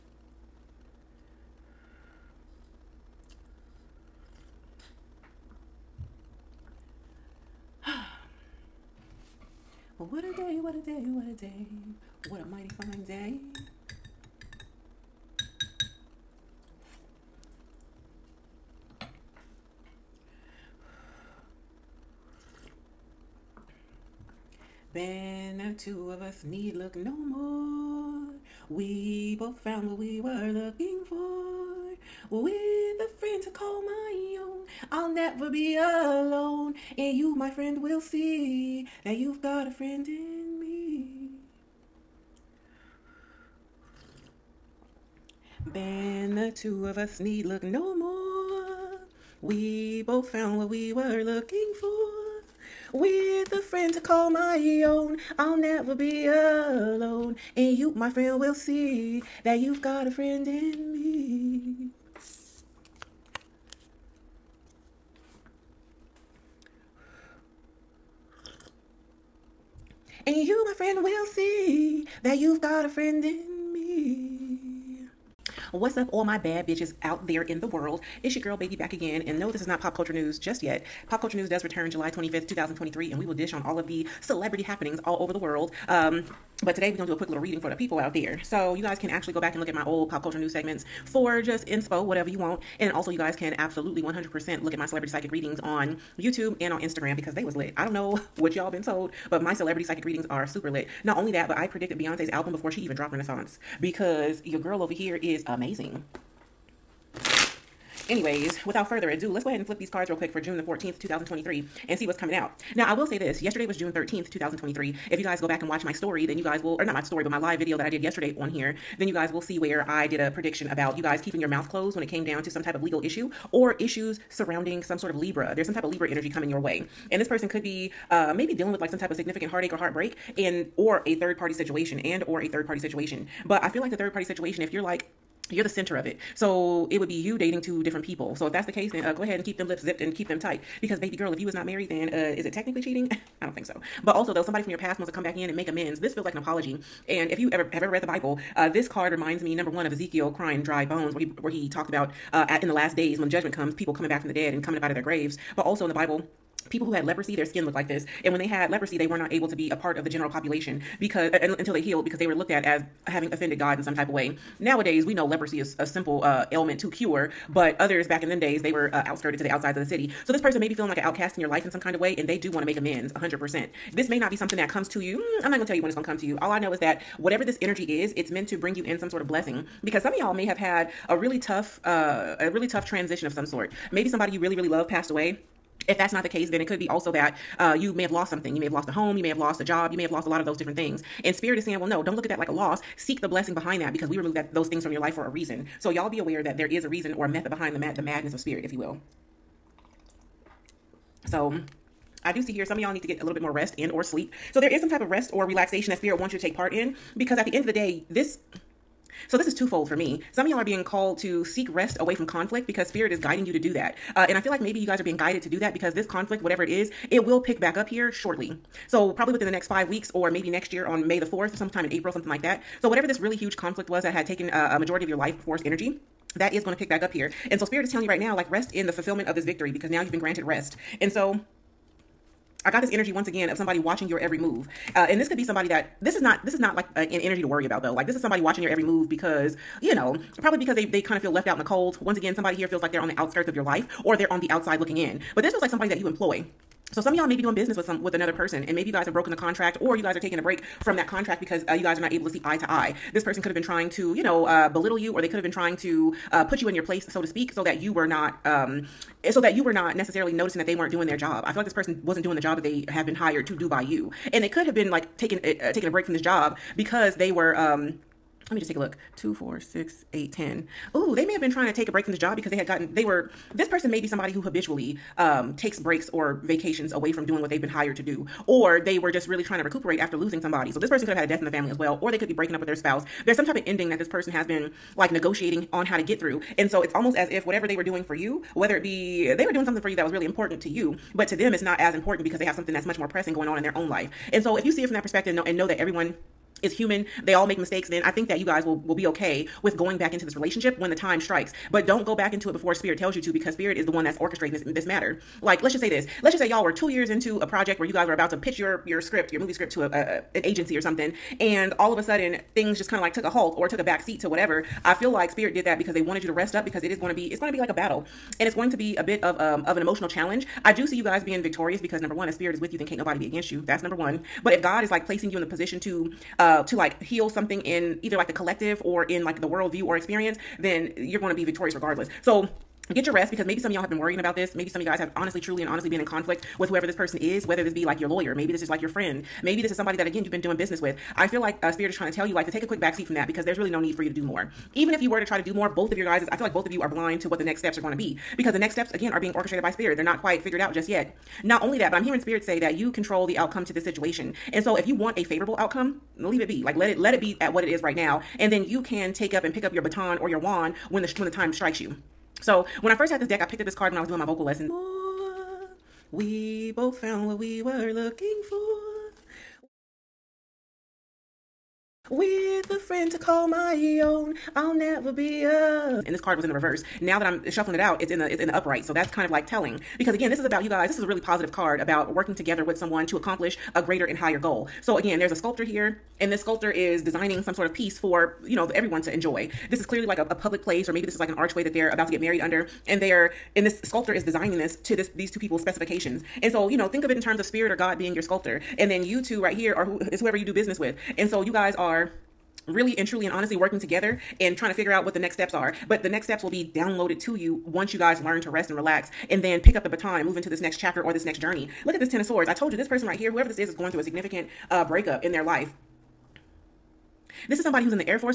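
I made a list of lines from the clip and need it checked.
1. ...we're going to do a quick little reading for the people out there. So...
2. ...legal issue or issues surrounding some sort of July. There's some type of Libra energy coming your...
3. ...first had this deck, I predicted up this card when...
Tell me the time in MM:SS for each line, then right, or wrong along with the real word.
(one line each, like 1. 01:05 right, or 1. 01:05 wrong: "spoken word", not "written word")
1. 01:26 right
2. 02:02 wrong: "Libra", not "July"
3. 06:02 wrong: "picked", not "predicted".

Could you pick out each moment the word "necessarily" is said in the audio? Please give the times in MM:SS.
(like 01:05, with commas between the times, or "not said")
04:19.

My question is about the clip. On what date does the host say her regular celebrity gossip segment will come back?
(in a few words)
July 25th, 2023.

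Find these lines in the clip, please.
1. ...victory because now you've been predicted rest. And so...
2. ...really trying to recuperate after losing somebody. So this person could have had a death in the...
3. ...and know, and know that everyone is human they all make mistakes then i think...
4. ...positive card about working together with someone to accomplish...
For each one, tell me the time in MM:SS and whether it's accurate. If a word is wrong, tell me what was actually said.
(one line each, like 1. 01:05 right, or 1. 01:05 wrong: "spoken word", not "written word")
1. 03:49 wrong: "granted", not "predicted"
2. 04:39 right
3. 04:55 right
4. 06:21 right.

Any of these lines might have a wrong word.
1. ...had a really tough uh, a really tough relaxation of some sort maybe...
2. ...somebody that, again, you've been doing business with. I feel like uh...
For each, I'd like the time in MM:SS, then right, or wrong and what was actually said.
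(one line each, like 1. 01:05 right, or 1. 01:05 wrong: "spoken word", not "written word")
1. 03:00 wrong: "transition", not "relaxation"
2. 05:39 right.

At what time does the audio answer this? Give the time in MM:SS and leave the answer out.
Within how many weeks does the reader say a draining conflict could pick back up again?
03:39.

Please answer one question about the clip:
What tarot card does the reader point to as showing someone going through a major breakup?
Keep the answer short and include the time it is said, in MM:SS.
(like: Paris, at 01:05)
Ten of Swords, at 06:52.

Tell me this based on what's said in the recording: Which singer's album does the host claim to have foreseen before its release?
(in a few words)
Beyonce.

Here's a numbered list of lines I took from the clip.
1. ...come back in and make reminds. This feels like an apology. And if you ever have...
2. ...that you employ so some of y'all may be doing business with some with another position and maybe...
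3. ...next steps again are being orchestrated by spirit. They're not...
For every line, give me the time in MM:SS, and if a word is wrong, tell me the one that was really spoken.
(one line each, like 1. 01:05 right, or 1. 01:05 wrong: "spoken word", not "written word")
1. 02:25 wrong: "amends", not "reminds"
2. 04:05 wrong: "person", not "position"
3. 05:48 right.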